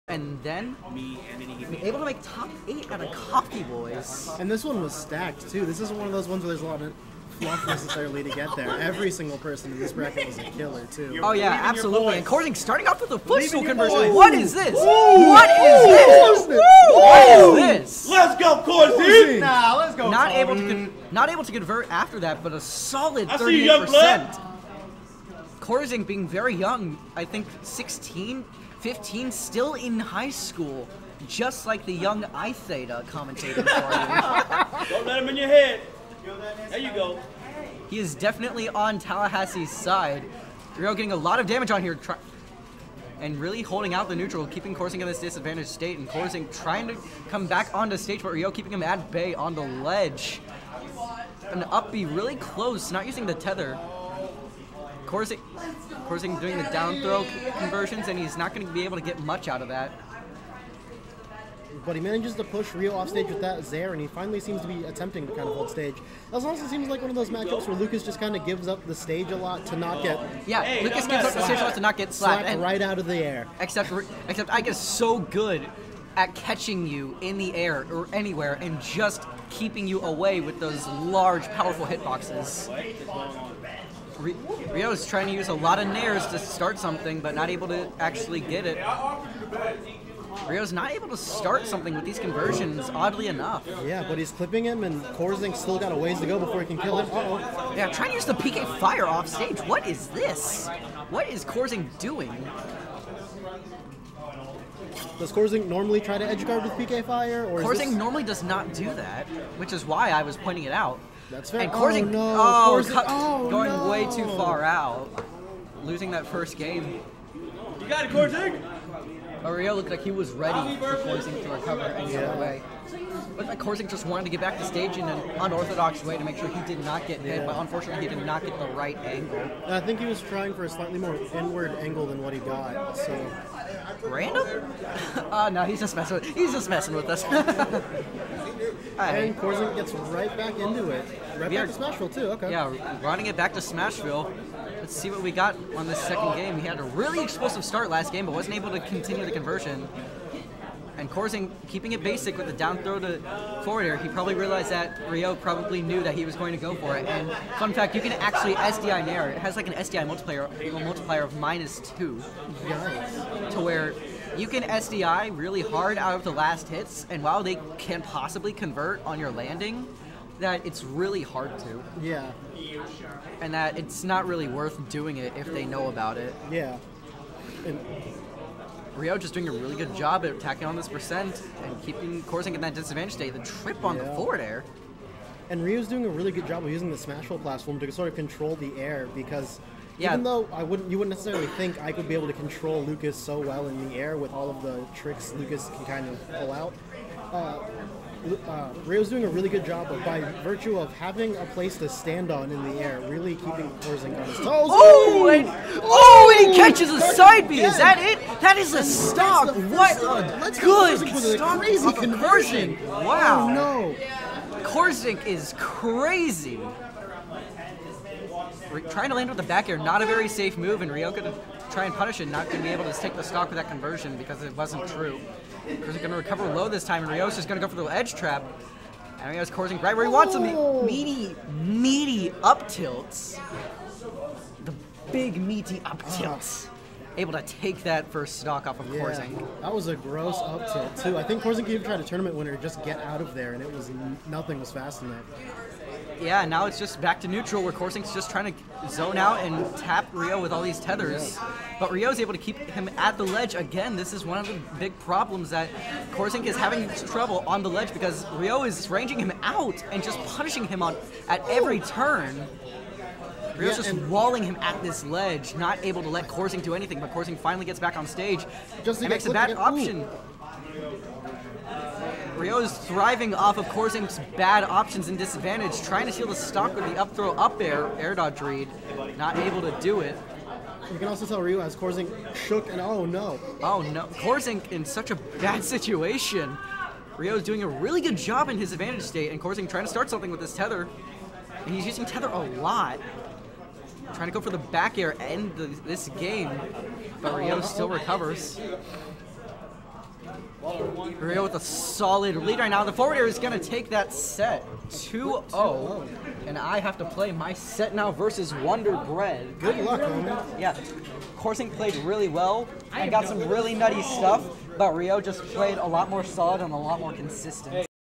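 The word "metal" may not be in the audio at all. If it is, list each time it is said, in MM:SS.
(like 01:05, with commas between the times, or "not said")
not said.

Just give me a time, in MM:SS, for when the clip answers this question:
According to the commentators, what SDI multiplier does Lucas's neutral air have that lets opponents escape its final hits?
02:41.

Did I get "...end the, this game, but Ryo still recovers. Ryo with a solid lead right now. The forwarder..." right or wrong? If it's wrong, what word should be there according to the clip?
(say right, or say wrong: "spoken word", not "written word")
right.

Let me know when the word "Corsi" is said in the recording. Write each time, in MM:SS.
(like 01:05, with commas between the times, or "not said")
00:18.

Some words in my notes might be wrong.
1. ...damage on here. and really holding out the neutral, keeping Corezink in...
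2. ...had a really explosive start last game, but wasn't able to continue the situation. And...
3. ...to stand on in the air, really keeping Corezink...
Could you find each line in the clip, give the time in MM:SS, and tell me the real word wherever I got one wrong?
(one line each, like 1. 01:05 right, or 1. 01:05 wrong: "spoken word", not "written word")
1. 00:41 right
2. 02:26 wrong: "conversion", not "situation"
3. 03:21 right.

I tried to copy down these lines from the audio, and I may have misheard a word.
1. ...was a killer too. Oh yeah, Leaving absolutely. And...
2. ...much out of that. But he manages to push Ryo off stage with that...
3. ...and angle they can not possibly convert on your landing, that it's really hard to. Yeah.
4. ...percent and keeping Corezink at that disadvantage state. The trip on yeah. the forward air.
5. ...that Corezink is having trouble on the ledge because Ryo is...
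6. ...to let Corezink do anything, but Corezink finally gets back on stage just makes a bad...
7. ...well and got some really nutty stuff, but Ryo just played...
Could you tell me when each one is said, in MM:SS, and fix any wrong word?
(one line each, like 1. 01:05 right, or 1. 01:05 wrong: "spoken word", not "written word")
1. 00:10 right
2. 00:59 right
3. 02:47 wrong: "while", not "angle"
4. 03:00 right
5. 04:15 right
6. 04:26 right
7. 05:12 right.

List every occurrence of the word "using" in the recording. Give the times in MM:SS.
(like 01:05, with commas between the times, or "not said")
00:53, 03:06, 04:51.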